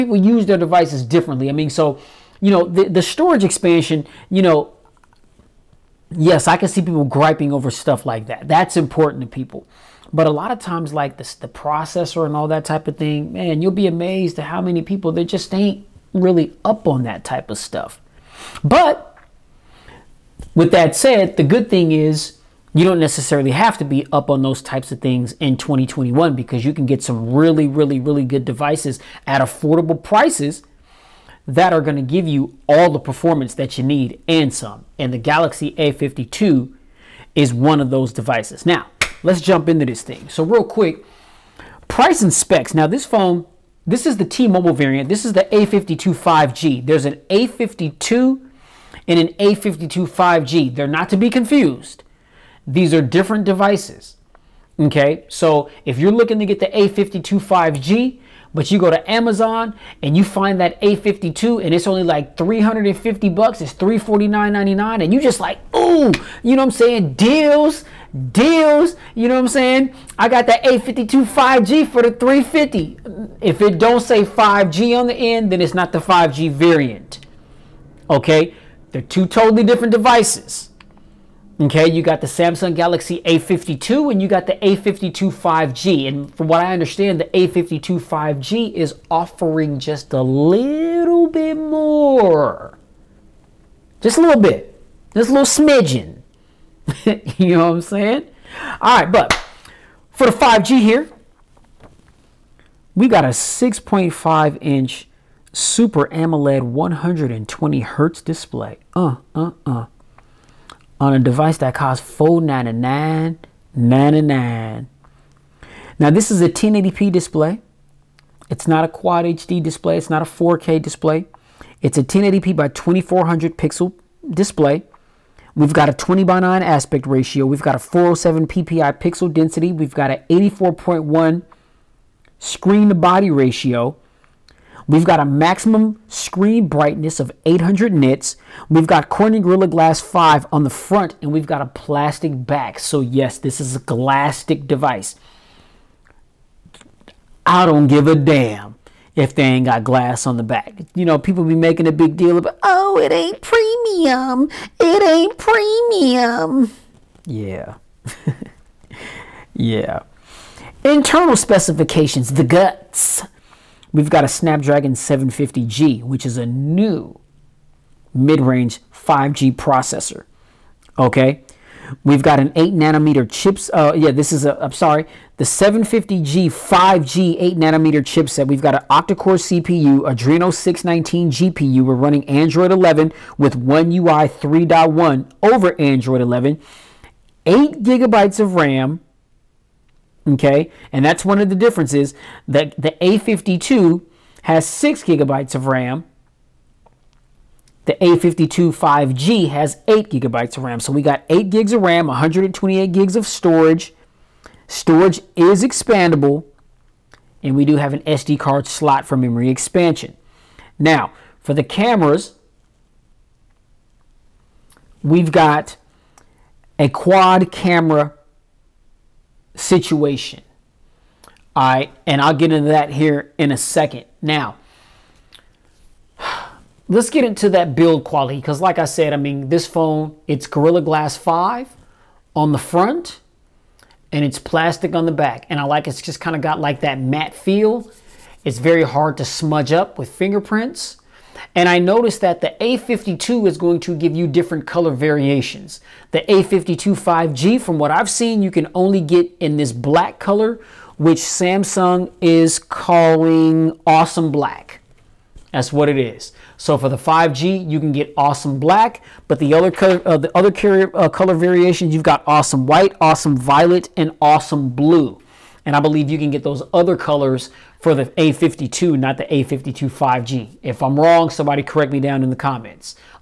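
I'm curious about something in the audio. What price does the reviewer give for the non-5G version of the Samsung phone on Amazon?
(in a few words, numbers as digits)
$349.99.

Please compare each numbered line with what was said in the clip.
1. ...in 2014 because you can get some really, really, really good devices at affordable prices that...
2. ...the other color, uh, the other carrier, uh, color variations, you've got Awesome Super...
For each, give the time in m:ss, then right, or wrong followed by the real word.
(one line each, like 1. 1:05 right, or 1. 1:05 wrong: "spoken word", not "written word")
1. 0:25 wrong: "2021", not "2014"
2. 4:19 wrong: "White", not "Super".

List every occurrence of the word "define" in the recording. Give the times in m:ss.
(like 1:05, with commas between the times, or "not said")
not said.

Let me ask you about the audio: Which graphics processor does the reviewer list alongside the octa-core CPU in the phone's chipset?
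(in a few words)
Adreno 619.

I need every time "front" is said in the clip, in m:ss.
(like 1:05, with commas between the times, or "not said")
2:20, 3:52.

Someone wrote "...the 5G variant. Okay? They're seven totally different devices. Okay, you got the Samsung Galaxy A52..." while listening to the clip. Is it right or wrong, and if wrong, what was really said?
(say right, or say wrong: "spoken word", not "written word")
wrong: "two", not "seven".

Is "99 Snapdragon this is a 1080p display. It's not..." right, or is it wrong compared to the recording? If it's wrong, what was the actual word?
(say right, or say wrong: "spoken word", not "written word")
wrong: "Now", not "Snapdragon".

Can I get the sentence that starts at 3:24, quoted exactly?
Storage is expandable, and we do have an SD card slot for memory expansion.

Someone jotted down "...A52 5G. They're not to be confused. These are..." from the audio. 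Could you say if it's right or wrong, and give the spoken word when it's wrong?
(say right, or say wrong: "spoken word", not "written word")
right.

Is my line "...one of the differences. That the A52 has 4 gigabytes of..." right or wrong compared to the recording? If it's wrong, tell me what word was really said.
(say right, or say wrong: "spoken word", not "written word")
wrong: "6", not "4".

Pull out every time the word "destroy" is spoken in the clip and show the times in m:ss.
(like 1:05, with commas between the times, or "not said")
not said.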